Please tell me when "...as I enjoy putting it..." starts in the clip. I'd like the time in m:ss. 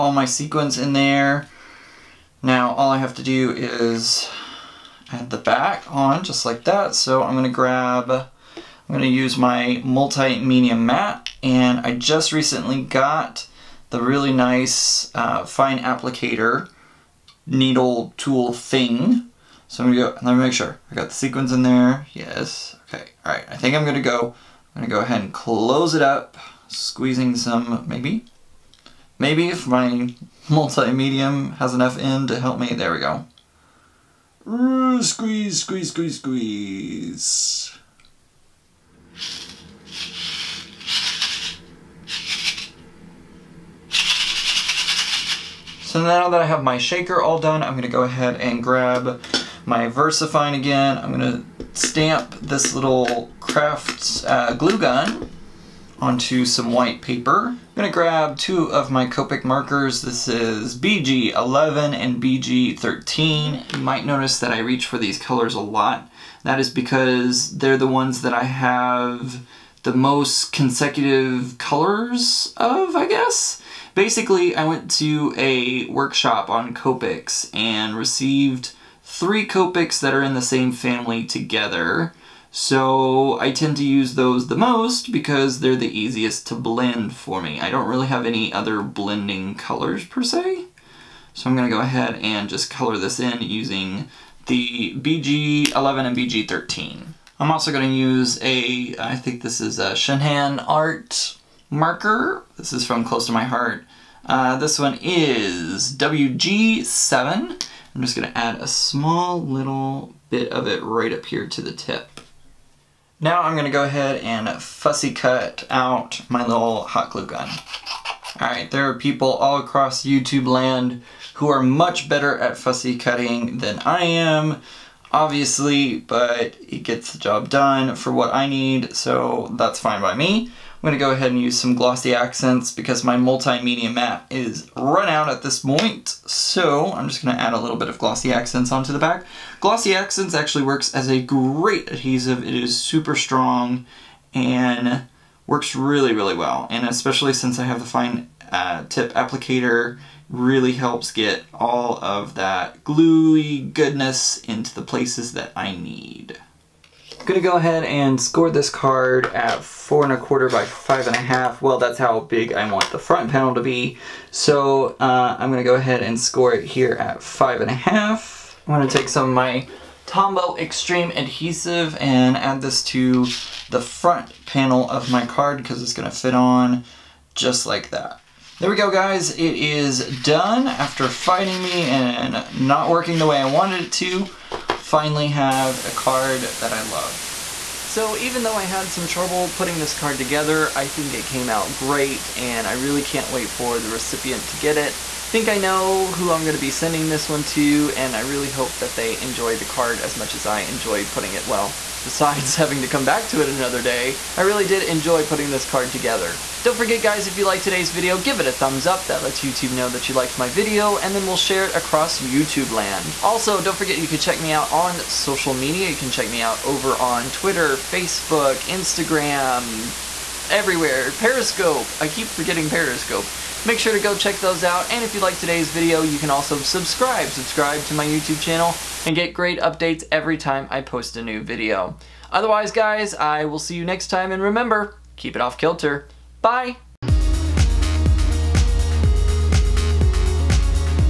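3:20.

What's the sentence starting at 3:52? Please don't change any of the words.
Otherwise, guys, I will see you next time.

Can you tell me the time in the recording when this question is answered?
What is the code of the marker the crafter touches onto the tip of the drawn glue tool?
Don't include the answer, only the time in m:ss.
1:45.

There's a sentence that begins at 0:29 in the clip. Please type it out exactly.
Maybe if my multi-medium has enough in to help me, there we go squeeze, squeeze, squeeze, squeeze.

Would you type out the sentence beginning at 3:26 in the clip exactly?
Don't forget guys, if you liked today's video, give it a thumbs up.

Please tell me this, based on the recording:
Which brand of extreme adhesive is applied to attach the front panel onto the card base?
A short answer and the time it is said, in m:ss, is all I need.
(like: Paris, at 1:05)
Tombow, at 2:50.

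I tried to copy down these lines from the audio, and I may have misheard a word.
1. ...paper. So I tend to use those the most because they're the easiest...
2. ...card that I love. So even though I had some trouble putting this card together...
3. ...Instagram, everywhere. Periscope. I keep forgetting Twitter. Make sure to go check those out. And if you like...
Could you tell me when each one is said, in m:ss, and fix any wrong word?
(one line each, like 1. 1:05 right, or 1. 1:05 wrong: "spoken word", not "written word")
1. 1:21 wrong: "together", not "paper"
2. 3:05 right
3. 3:38 wrong: "Periscope", not "Twitter".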